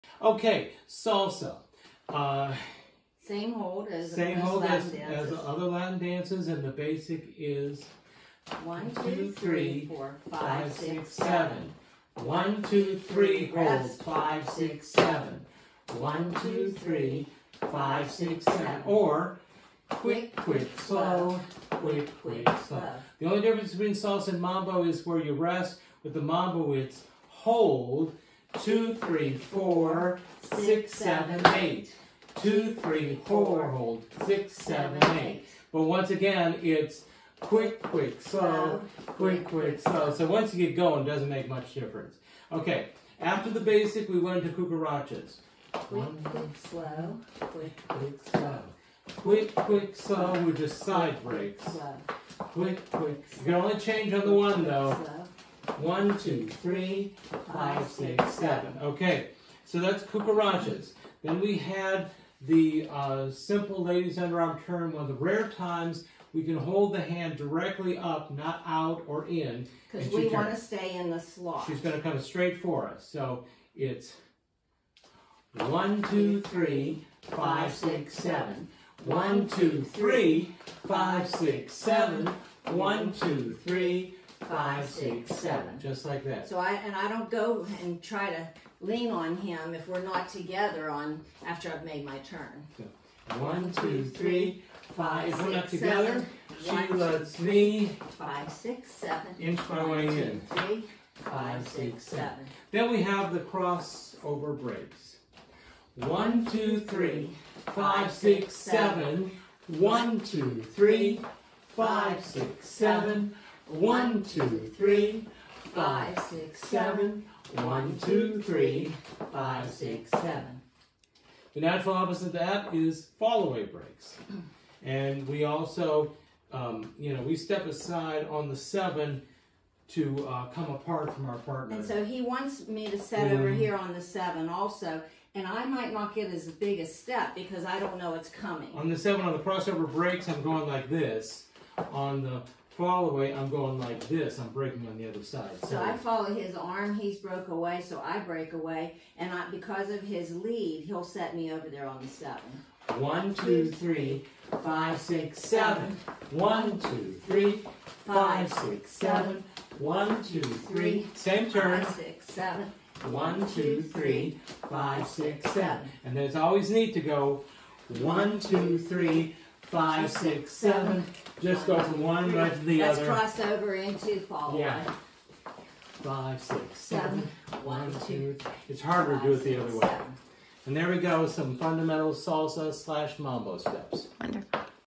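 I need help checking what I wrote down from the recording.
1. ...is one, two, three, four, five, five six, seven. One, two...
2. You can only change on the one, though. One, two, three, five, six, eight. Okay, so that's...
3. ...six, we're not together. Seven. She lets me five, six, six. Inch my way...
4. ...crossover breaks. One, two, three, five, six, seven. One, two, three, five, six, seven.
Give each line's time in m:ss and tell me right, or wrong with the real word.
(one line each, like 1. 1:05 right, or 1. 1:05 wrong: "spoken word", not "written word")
1. 0:07 right
2. 0:53 wrong: "seven", not "eight"
3. 1:35 wrong: "seven", not "six"
4. 1:43 right.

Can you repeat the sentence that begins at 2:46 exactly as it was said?
And there's always need to go one, two, three, five, six, seven.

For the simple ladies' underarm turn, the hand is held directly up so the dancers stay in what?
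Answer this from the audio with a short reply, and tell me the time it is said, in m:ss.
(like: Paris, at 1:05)
The slot, at 1:11.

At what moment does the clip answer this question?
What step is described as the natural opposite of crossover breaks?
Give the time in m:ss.
2:03.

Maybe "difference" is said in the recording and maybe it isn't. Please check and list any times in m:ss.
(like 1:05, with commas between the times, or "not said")
0:23, 0:41.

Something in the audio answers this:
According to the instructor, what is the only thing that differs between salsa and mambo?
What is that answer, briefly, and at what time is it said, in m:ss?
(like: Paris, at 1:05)
Where you rest, at 0:25.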